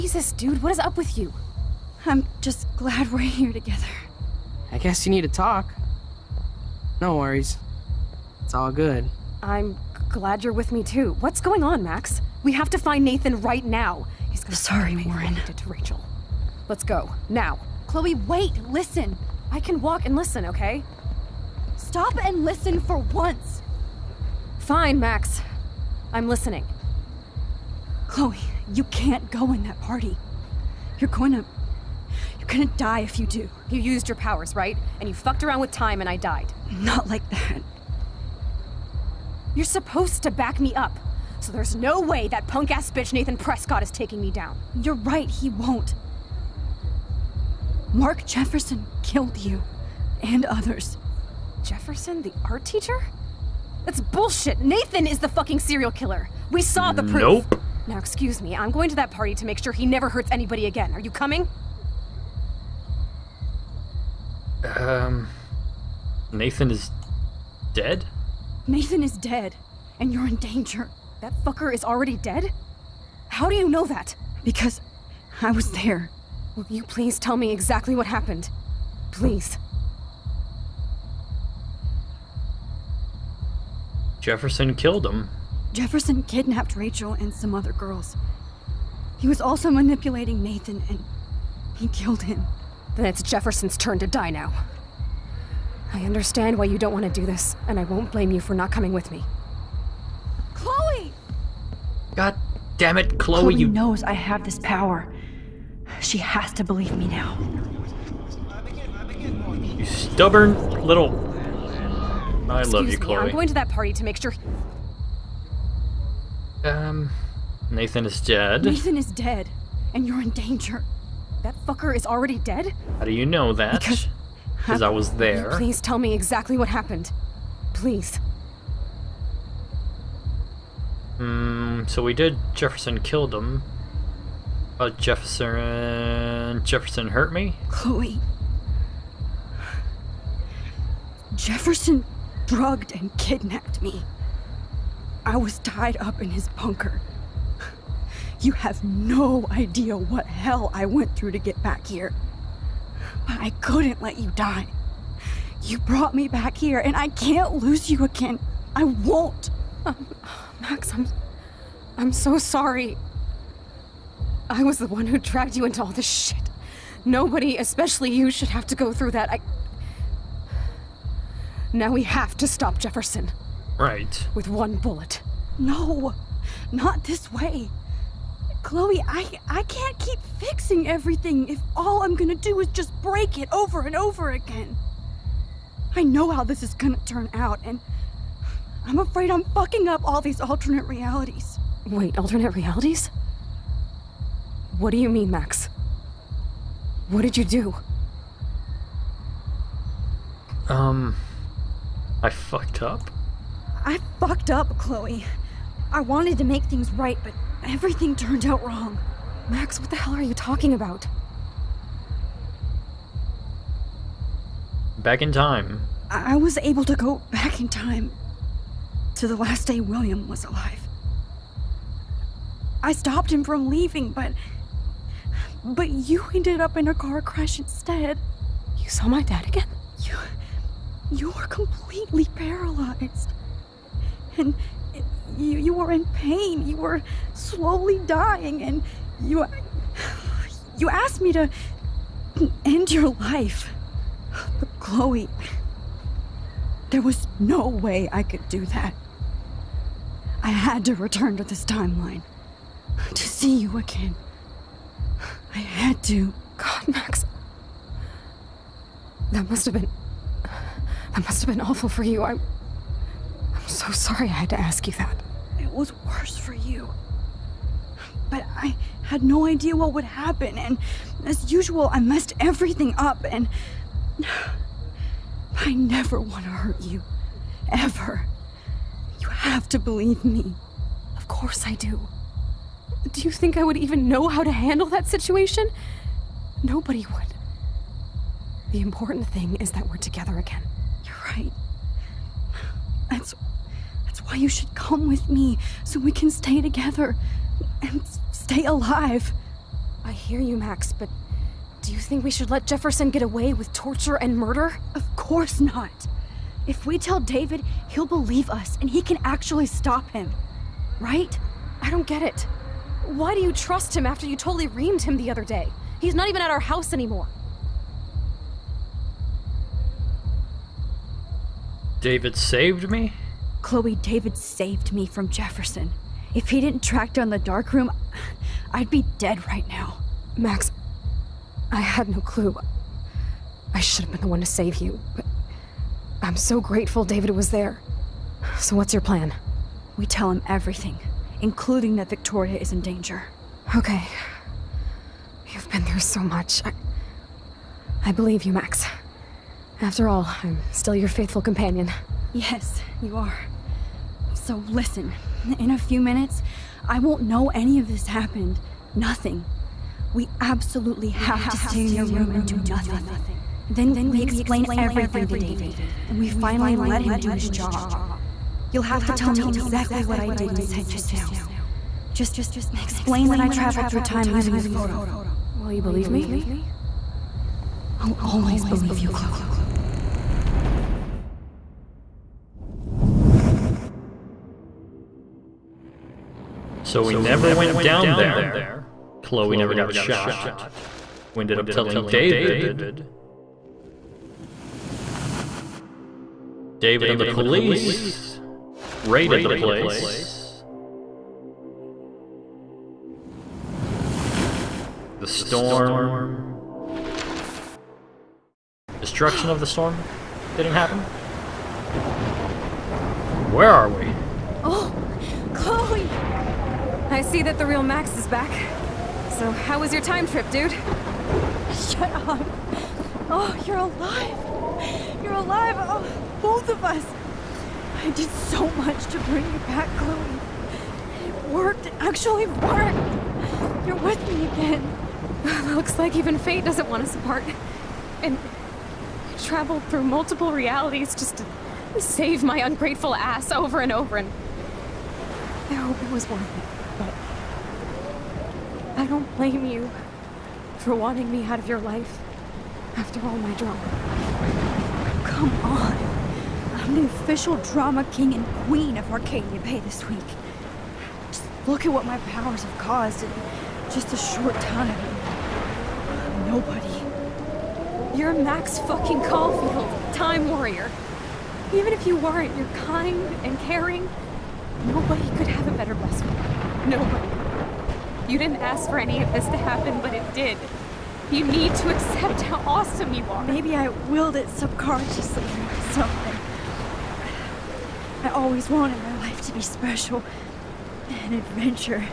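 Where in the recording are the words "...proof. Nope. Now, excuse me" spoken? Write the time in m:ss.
0:57.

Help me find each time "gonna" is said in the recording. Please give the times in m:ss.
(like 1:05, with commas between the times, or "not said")
0:14, 0:32, 3:02, 3:06.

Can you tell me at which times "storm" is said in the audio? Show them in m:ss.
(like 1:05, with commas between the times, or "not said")
6:45, 6:49.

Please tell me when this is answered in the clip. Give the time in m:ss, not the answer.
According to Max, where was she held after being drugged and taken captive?
2:26.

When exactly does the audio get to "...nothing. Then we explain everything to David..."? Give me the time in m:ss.
6:02.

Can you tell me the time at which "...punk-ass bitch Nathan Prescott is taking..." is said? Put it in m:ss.
0:42.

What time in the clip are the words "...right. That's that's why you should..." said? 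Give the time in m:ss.
4:51.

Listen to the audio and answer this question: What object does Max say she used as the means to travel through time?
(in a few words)
the photo.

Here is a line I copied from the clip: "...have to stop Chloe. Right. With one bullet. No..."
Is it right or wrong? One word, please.
wrong.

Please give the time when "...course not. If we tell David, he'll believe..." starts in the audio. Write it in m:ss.
5:05.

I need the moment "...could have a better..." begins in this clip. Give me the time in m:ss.
7:55.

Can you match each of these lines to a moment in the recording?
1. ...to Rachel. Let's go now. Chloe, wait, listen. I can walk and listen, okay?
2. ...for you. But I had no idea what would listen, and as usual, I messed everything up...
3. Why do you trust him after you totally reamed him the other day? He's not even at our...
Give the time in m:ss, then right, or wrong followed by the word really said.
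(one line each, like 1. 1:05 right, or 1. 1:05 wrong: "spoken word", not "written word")
1. 0:15 right
2. 4:26 wrong: "happen", not "listen"
3. 5:13 right.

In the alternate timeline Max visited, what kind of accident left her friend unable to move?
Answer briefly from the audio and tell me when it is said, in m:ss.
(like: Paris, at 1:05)
car crash, at 3:46.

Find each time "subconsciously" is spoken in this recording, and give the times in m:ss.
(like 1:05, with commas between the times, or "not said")
8:04.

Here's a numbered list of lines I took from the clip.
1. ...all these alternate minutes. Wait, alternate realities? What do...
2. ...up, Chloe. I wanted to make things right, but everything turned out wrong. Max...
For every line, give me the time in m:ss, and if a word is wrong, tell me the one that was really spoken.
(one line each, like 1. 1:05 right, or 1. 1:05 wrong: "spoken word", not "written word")
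1. 3:10 wrong: "realities", not "minutes"
2. 3:24 right.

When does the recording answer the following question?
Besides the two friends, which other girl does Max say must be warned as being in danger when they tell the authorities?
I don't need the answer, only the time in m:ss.
5:42.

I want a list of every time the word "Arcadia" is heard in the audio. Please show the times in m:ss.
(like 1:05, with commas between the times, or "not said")
7:39.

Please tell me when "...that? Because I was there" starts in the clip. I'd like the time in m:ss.
1:13.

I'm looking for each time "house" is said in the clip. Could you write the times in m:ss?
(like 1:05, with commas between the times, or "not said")
5:16.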